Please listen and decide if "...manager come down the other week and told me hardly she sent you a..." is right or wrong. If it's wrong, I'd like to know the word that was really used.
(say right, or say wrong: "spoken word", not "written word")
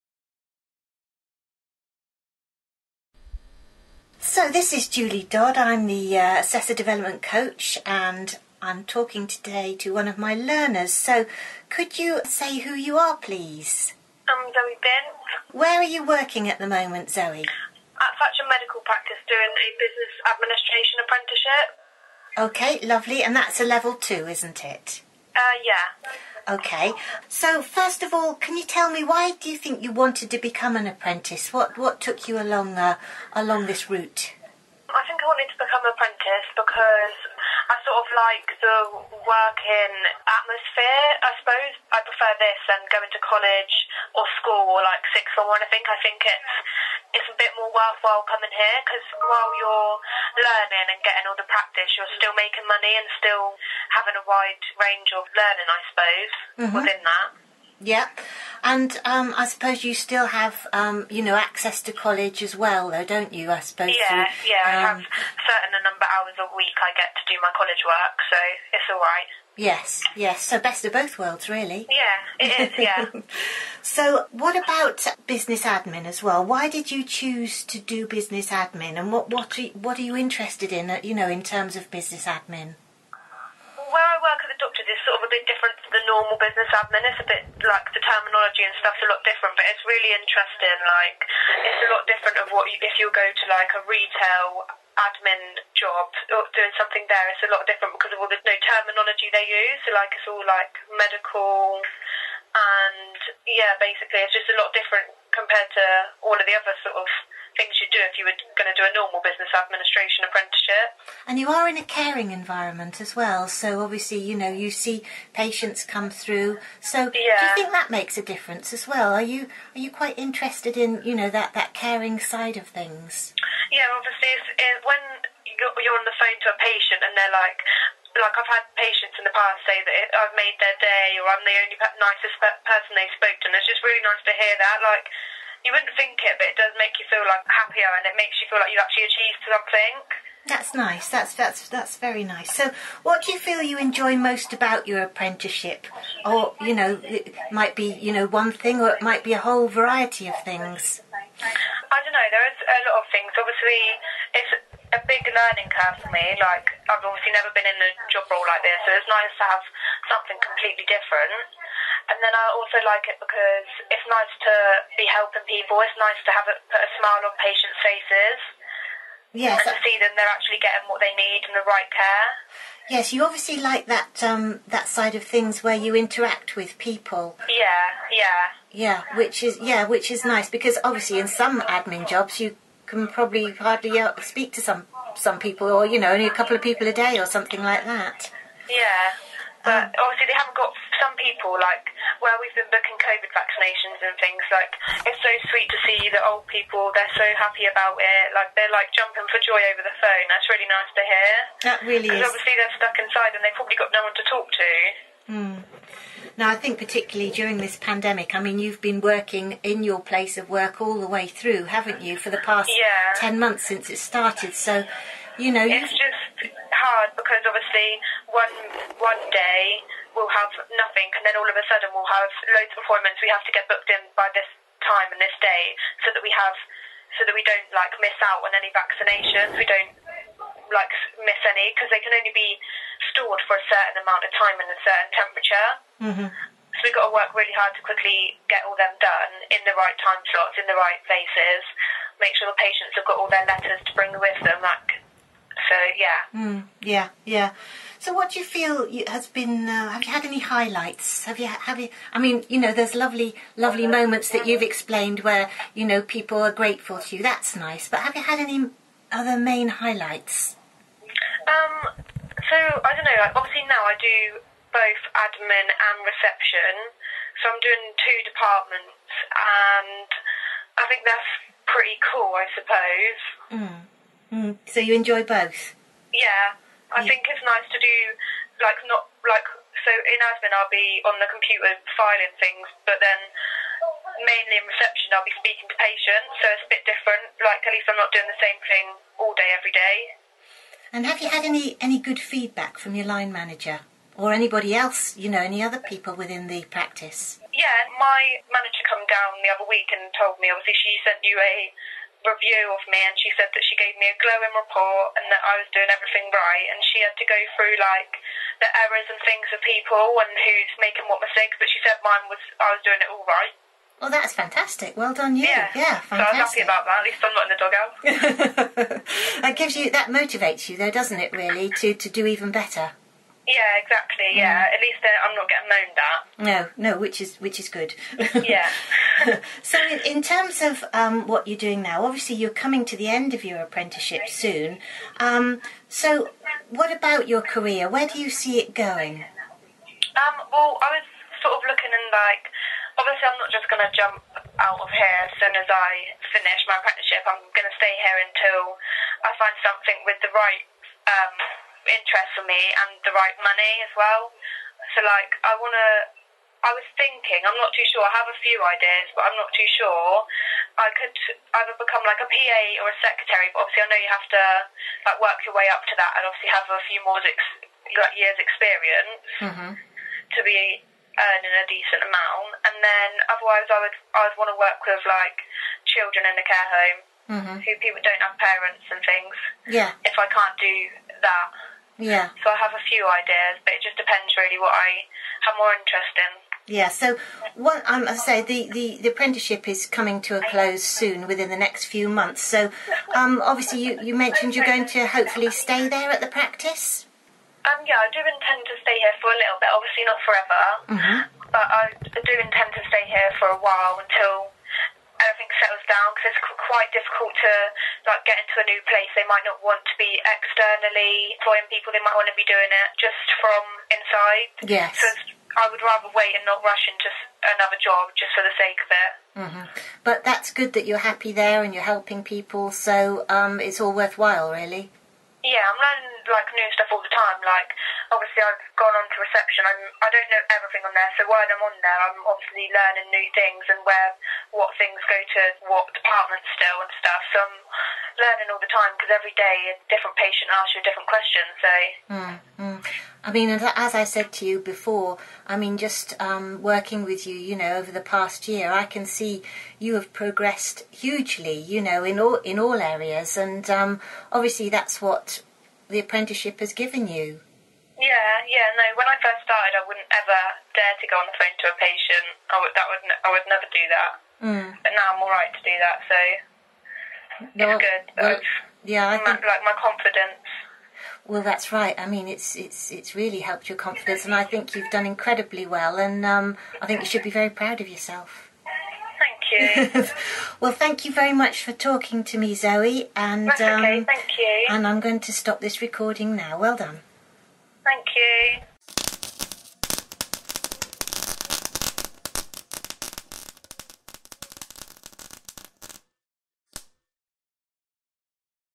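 wrong: "obviously", not "hardly".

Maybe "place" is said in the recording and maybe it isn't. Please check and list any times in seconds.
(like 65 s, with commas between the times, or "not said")
210 s, 241 s, 408 s.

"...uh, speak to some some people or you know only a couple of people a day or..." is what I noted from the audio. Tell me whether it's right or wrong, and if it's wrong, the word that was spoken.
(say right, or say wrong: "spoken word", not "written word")
right.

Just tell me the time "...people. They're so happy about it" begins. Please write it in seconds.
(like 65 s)
196 s.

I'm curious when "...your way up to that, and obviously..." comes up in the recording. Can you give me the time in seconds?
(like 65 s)
365 s.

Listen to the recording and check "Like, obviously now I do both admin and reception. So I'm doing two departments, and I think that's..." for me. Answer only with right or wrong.
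right.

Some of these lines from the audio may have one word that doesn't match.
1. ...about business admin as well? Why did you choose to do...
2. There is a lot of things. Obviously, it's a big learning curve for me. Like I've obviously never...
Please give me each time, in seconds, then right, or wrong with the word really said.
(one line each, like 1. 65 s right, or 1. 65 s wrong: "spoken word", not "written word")
1. 74 s right
2. 152 s right.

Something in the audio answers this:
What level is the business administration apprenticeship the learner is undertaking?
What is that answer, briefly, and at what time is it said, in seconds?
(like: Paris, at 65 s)
Level 2, at 23 s.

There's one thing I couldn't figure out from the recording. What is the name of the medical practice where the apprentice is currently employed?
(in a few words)
Thatcham Medical Practice.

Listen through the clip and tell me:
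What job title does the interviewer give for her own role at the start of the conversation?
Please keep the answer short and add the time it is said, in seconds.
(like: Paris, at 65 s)
Assessor Development Coach, at 6 s.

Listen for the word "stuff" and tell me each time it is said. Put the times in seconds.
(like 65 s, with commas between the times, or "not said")
88 s, 426 s, 437 s.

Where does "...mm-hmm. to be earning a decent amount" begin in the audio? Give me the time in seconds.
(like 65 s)
369 s.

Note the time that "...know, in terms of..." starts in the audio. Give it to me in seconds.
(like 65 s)
81 s.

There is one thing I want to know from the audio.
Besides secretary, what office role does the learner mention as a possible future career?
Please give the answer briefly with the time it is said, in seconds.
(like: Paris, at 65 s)
PA, at 362 s.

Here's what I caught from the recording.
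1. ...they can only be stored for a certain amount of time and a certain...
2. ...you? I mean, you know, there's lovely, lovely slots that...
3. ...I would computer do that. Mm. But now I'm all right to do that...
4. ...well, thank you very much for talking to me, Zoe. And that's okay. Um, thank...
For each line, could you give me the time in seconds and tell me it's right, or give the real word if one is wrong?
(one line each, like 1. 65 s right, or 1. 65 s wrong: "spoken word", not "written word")
1. 231 s right
2. 251 s wrong: "moments", not "slots"
3. 463 s wrong: "never", not "computer"
4. 480 s right.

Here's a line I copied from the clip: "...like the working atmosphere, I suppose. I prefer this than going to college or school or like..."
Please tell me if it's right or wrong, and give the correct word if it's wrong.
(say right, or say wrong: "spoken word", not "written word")
right.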